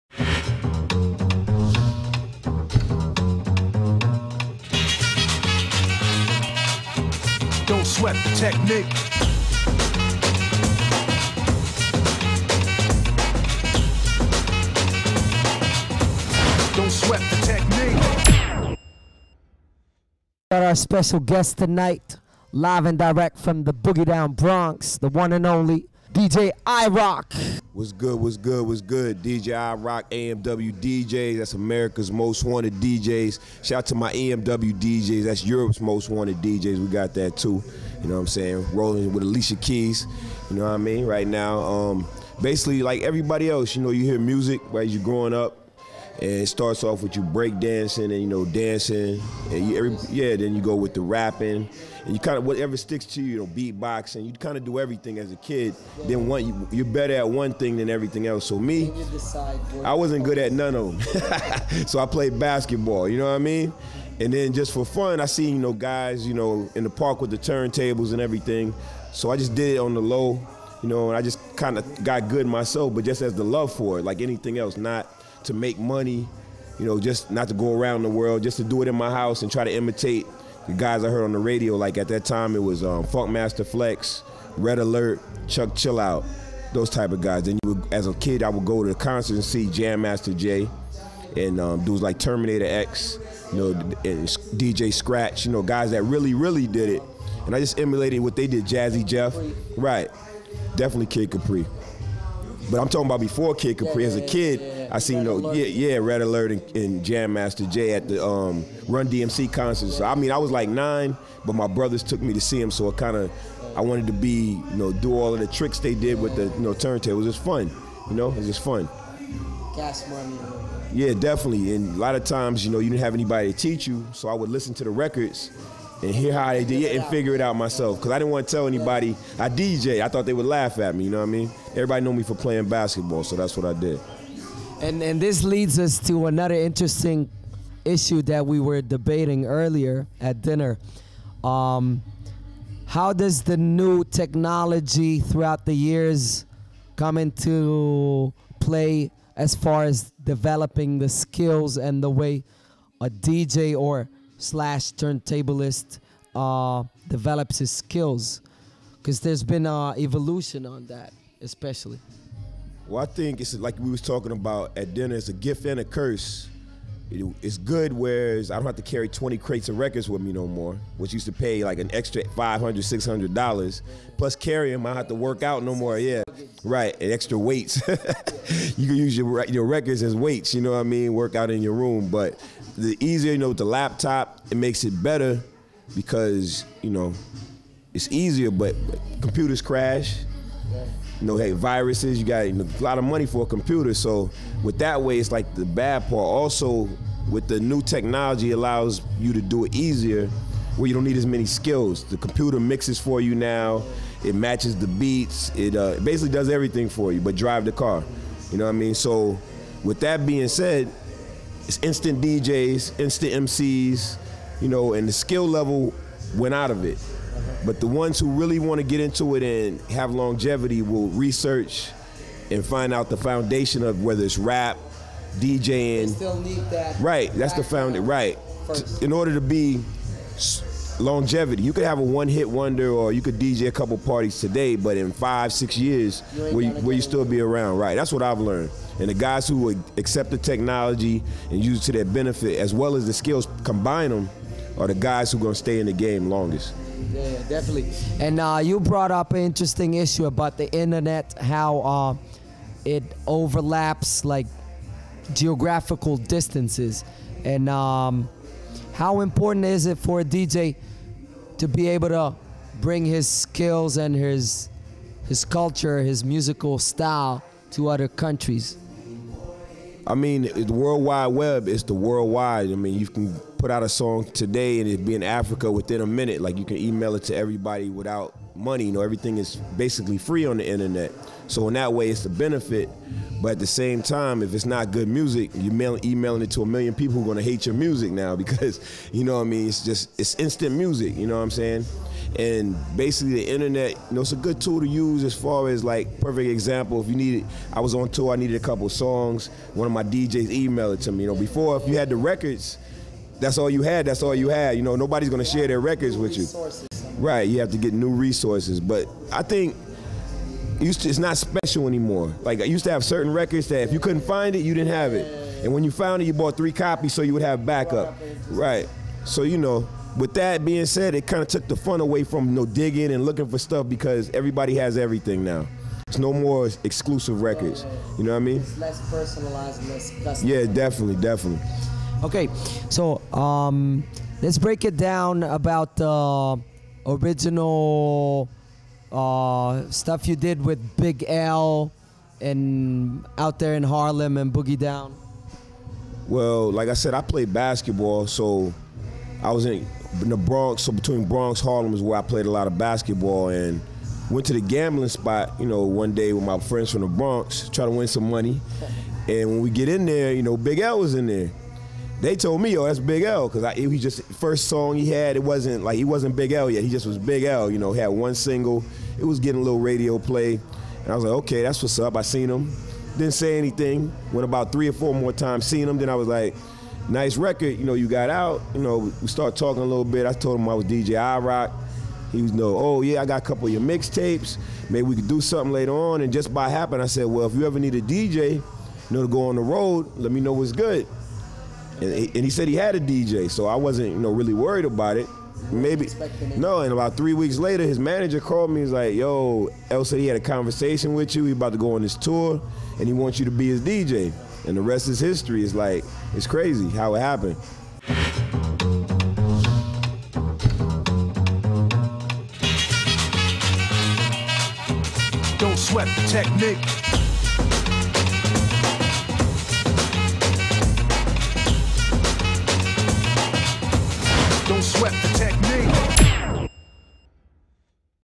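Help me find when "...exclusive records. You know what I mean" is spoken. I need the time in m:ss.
5:26.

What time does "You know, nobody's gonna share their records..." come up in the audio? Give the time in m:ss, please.
5:04.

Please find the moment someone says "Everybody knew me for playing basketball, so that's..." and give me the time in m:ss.
2:11.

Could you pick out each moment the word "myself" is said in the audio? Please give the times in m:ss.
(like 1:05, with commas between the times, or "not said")
1:12, 2:07.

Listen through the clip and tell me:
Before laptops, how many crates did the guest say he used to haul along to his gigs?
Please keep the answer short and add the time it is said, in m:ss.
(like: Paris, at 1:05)
20, at 2:49.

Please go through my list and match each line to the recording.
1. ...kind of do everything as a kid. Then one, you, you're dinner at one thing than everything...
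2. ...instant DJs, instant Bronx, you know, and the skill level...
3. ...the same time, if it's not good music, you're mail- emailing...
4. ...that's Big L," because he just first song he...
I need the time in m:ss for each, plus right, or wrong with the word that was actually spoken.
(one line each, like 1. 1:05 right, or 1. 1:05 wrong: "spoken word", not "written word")
1. 0:54 wrong: "better", not "dinner"
2. 3:31 wrong: "MCs", not "Bronx"
3. 4:43 right
4. 6:02 right.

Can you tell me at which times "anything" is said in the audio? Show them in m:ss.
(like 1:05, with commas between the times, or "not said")
1:14, 6:13.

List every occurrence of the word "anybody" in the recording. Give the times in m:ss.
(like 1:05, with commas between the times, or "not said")
2:03, 2:08.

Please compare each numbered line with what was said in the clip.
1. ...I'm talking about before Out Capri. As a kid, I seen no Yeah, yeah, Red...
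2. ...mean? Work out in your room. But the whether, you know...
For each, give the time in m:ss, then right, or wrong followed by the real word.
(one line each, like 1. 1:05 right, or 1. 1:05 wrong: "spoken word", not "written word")
1. 1:42 wrong: "Kid", not "Out"
2. 3:00 wrong: "easier", not "whether".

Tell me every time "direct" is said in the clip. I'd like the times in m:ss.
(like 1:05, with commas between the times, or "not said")
0:22.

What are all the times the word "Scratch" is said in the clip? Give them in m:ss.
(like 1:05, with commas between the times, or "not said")
1:34.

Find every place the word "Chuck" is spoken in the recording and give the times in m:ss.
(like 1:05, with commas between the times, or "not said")
1:25.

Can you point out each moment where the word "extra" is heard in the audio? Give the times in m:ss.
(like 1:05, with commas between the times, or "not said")
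2:51, 2:57.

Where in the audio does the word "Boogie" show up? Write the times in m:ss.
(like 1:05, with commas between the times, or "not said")
0:23, 5:44.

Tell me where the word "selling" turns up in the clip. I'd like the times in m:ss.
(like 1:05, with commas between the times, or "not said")
not said.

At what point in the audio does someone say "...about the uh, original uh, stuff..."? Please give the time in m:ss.
5:35.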